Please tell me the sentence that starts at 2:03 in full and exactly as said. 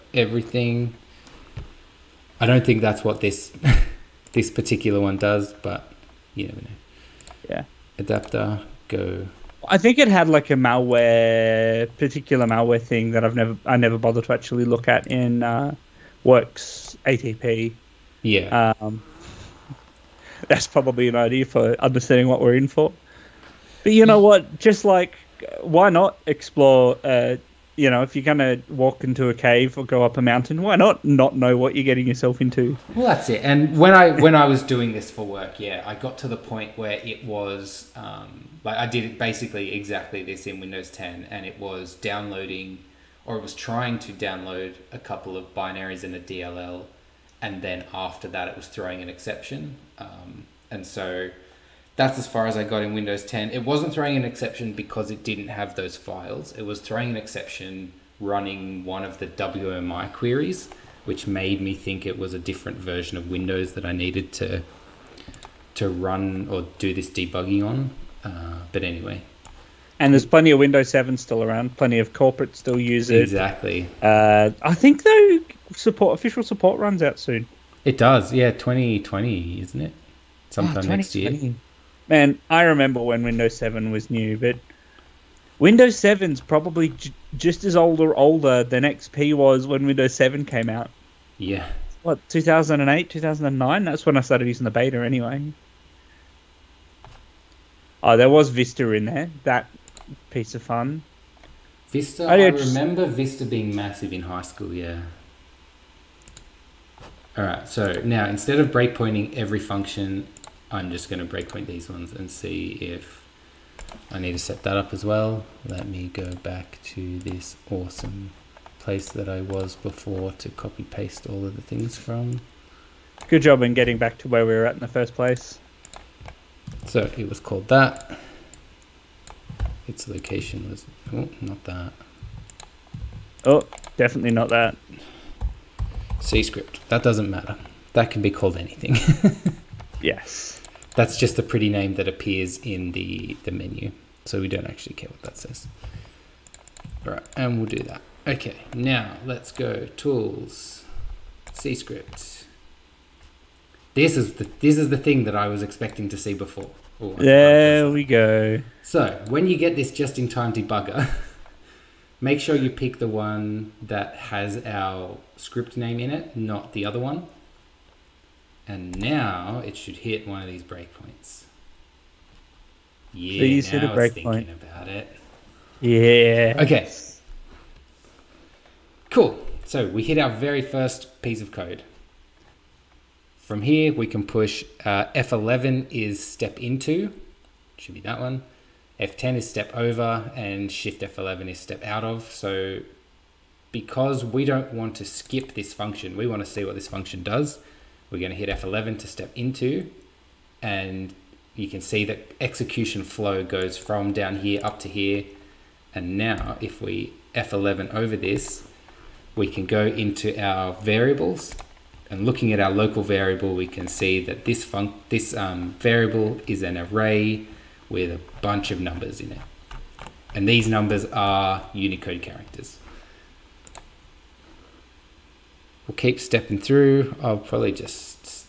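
Good job in getting back to where we were at in the first place.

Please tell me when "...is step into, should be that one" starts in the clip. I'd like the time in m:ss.
3:05.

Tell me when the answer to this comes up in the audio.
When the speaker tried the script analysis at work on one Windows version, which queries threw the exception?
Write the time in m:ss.
0:59.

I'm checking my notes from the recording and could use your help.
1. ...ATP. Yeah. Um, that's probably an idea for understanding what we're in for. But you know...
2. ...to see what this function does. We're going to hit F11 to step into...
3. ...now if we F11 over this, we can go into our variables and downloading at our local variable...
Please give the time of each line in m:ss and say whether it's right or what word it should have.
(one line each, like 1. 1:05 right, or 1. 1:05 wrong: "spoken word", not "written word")
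1. 0:17 right
2. 3:16 right
3. 3:26 wrong: "looking", not "downloading".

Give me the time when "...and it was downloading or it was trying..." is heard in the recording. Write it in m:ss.
0:41.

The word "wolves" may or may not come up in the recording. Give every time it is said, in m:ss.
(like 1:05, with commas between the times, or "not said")
not said.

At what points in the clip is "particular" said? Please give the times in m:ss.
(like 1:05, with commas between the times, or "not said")
0:04, 0:11.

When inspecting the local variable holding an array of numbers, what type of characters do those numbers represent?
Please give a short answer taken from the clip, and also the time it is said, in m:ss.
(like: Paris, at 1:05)
Unicode characters, at 3:41.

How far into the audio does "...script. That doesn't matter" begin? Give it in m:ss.
2:16.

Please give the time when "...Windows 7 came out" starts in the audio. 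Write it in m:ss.
1:29.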